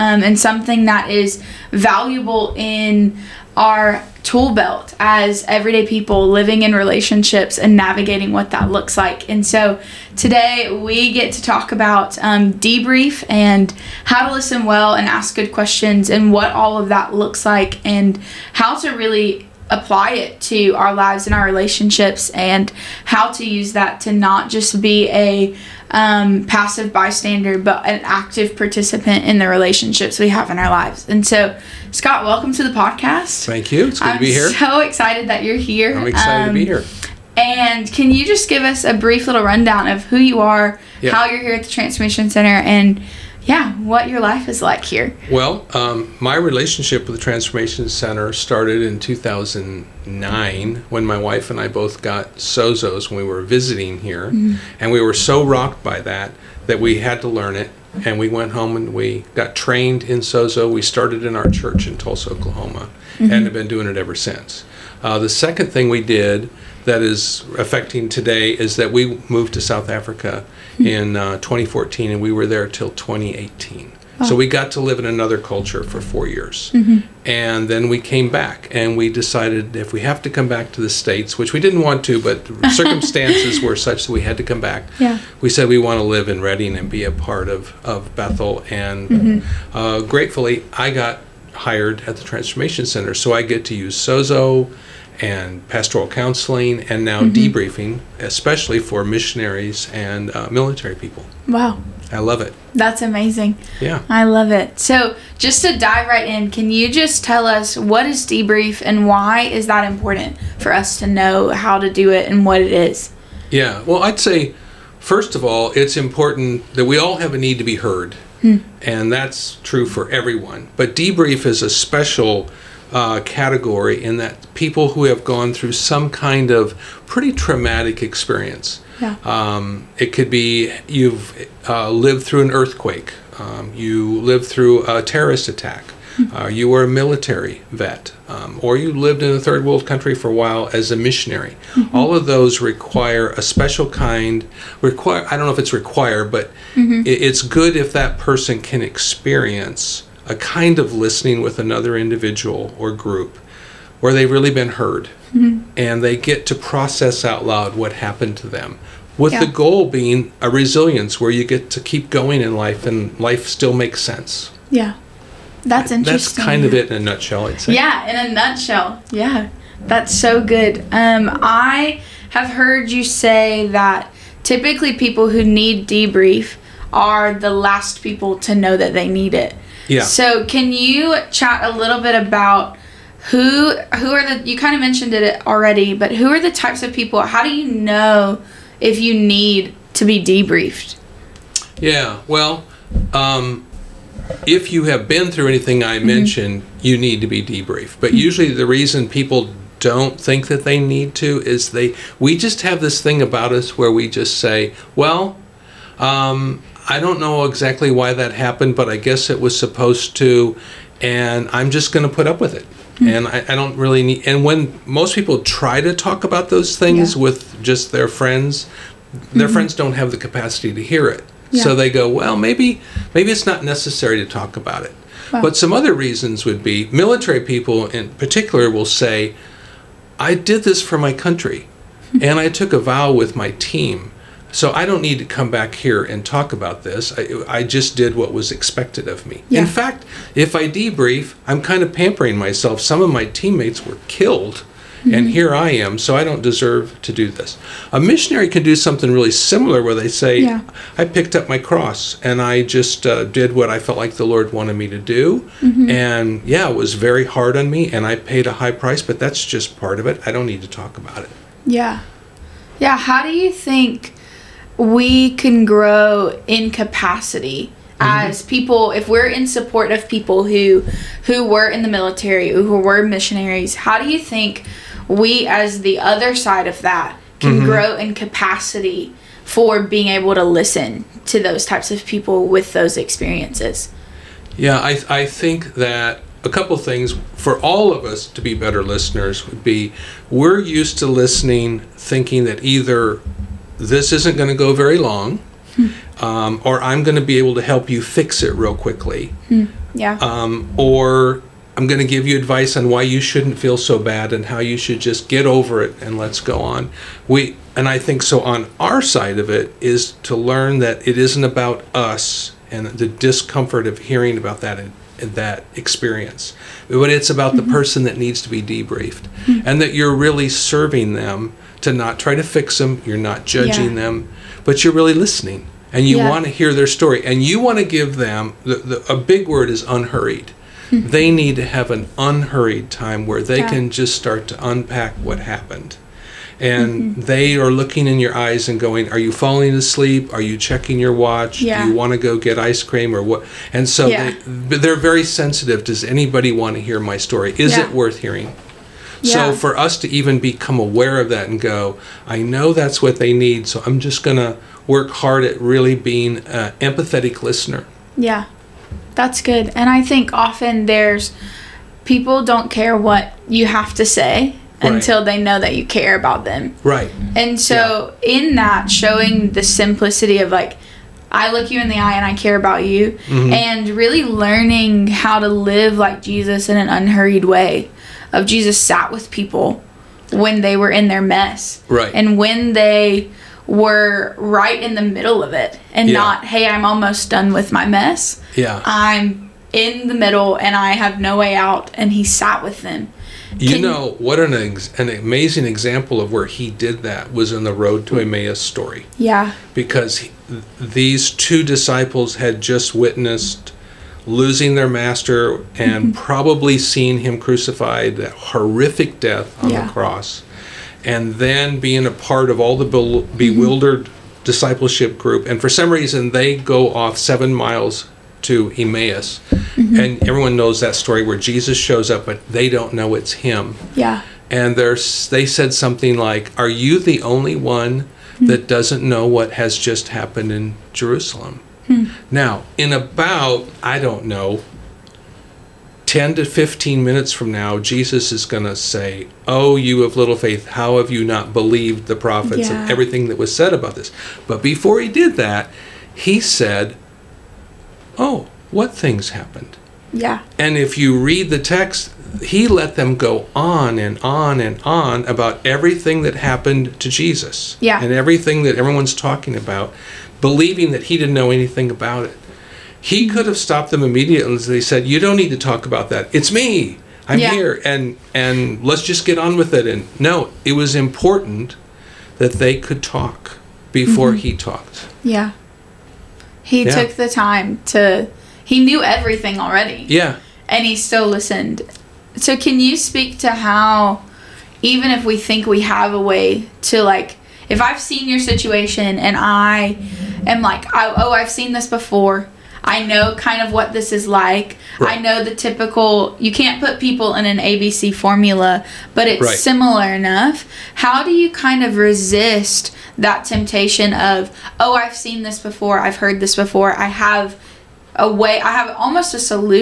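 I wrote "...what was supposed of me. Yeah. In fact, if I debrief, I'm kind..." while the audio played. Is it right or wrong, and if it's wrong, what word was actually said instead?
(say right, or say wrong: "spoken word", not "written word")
wrong: "expected", not "supposed".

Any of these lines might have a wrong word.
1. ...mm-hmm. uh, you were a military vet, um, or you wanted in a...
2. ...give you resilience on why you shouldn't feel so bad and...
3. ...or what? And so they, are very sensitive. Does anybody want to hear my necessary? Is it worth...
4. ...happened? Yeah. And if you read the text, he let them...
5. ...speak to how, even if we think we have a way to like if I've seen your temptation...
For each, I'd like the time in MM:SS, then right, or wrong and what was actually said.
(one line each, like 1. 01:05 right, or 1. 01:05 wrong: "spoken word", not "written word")
1. 02:16 wrong: "lived", not "wanted"
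2. 05:02 wrong: "advice", not "resilience"
3. 05:43 wrong: "story", not "necessary"
4. 07:29 right
5. 08:02 wrong: "situation", not "temptation".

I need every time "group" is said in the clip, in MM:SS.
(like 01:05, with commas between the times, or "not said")
02:32, 06:55.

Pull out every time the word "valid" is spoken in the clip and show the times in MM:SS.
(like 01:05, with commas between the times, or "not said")
not said.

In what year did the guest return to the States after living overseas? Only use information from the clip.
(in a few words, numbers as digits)
2018.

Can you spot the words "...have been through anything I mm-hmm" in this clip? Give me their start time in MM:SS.
03:14.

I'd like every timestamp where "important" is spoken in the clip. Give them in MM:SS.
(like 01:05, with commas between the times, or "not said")
01:49, 01:55, 07:50.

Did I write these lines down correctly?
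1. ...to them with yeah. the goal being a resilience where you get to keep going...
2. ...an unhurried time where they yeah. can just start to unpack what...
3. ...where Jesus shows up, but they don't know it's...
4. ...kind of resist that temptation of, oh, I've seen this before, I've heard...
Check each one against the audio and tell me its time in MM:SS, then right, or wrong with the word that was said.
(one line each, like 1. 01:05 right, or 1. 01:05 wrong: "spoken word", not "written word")
1. 02:38 right
2. 05:31 right
3. 07:01 right
4. 08:21 right.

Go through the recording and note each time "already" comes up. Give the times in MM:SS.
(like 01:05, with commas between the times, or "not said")
03:05, 07:59.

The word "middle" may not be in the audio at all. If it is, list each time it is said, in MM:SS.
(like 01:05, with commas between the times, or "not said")
06:25, 06:30.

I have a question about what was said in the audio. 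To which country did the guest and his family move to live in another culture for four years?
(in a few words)
South Africa.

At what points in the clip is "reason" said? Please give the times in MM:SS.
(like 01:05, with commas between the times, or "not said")
03:18, 03:45, 06:55.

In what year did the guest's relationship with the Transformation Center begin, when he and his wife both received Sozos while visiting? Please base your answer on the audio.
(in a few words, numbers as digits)
2009.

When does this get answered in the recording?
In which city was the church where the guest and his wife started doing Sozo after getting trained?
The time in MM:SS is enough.
01:01.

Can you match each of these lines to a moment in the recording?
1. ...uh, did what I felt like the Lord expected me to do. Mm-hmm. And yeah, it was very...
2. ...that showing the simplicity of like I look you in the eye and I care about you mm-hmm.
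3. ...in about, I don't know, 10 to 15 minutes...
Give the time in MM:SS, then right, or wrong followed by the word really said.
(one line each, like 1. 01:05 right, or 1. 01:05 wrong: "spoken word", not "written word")
1. 04:13 wrong: "wanted", not "expected"
2. 06:08 right
3. 07:12 right.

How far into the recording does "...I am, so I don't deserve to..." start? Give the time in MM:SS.
04:05.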